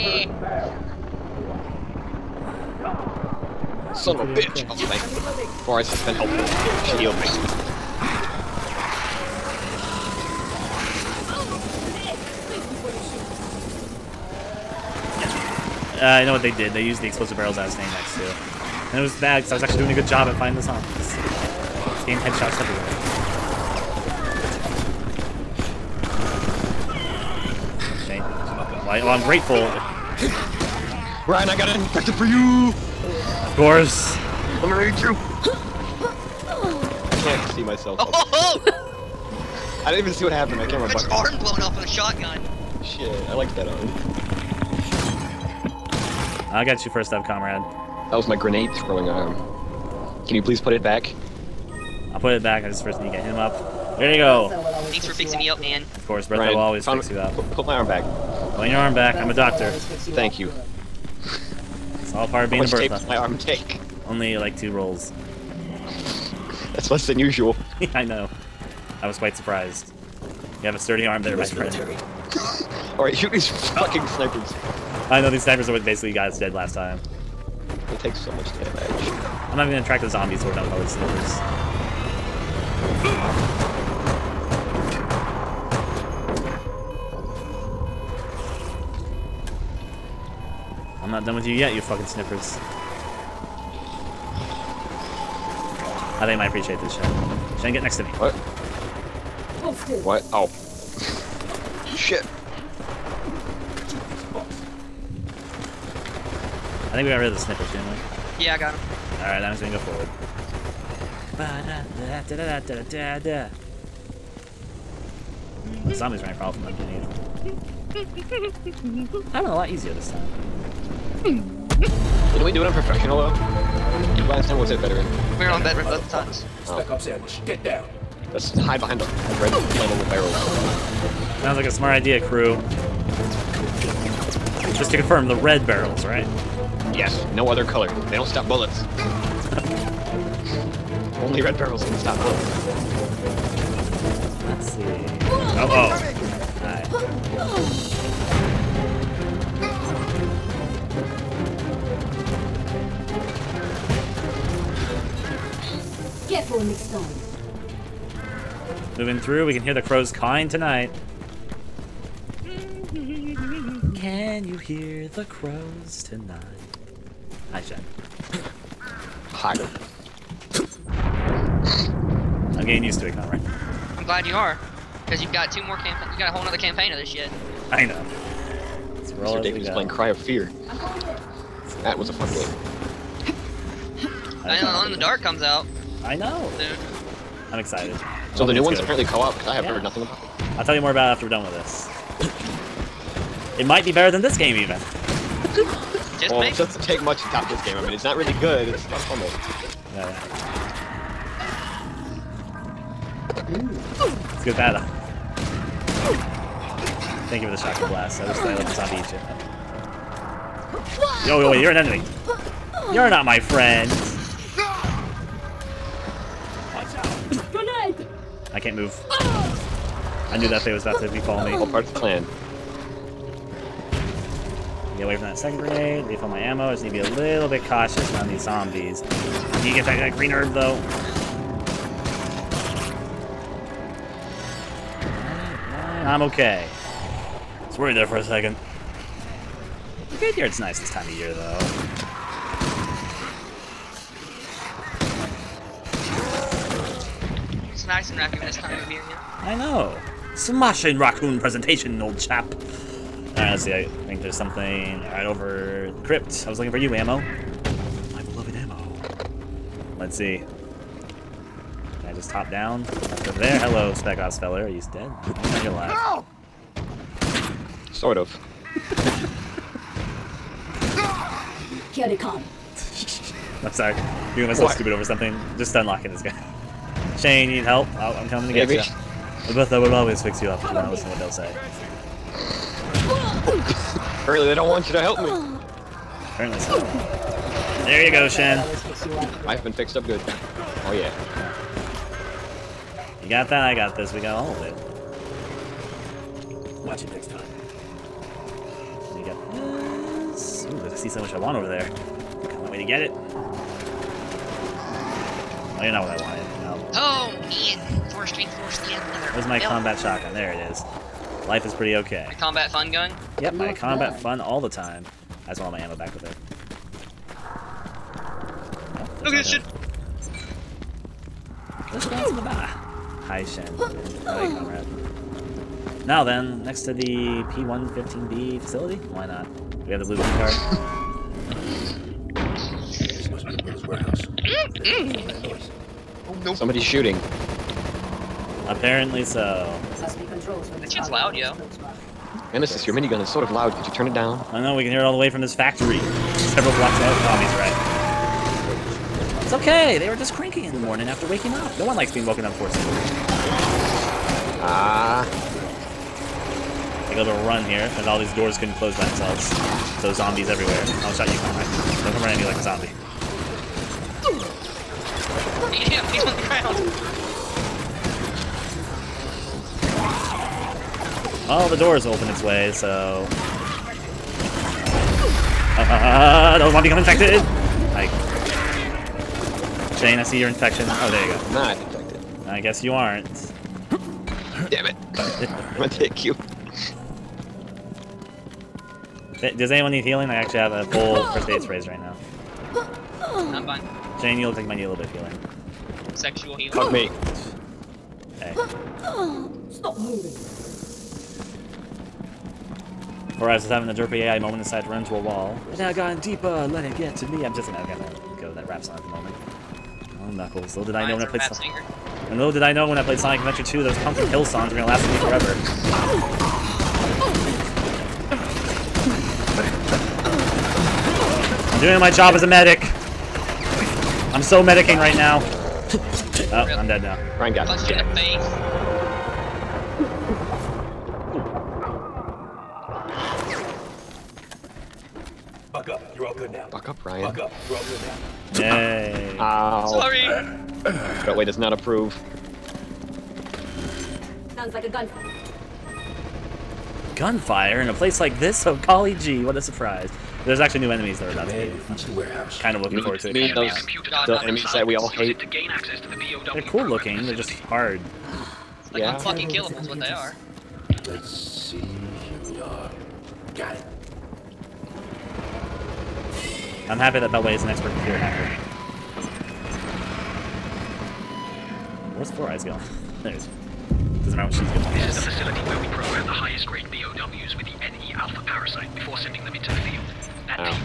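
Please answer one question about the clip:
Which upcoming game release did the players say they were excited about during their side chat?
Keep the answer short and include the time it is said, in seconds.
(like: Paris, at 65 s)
Alone in the Dark, at 184 s.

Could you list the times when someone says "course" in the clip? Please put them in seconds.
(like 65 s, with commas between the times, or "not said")
33 s, 56 s.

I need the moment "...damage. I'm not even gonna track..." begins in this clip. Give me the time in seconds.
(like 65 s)
78 s.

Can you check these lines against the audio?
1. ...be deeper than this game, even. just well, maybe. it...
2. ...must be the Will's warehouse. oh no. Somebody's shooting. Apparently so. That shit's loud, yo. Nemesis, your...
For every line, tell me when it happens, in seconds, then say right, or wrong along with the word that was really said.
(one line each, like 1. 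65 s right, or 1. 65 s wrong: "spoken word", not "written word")
1. 193 s wrong: "better", not "deeper"
2. 333 s right.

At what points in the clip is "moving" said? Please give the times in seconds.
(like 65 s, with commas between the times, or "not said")
158 s, 399 s.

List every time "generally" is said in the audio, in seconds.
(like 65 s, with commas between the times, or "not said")
not said.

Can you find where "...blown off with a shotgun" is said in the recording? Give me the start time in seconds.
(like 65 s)
41 s.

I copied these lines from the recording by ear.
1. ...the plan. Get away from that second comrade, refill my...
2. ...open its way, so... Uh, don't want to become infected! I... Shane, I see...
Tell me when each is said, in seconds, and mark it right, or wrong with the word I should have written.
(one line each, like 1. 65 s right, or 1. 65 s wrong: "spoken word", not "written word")
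1. 221 s wrong: "grenade", not "comrade"
2. 372 s right.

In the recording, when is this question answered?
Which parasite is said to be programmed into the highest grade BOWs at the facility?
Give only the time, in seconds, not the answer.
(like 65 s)
477 s.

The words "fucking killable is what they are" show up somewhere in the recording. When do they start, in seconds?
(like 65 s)
459 s.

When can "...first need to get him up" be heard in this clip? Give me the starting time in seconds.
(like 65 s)
52 s.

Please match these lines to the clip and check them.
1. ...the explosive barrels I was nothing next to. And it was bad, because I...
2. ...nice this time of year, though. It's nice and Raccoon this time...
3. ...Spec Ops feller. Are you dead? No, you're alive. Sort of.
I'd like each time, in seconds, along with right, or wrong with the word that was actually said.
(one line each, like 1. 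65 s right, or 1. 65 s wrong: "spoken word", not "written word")
1. 16 s wrong: "staying", not "nothing"
2. 240 s right
3. 263 s right.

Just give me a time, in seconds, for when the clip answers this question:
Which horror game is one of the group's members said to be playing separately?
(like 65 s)
179 s.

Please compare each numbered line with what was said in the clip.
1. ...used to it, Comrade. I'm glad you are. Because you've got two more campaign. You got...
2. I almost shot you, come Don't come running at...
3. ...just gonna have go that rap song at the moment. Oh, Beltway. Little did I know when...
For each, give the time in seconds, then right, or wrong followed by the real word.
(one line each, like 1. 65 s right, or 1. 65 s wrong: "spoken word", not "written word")
1. 172 s right
2. 360 s right
3. 407 s wrong: "Knuckles", not "Beltway".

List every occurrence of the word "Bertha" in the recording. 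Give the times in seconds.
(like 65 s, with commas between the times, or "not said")
56 s, 62 s.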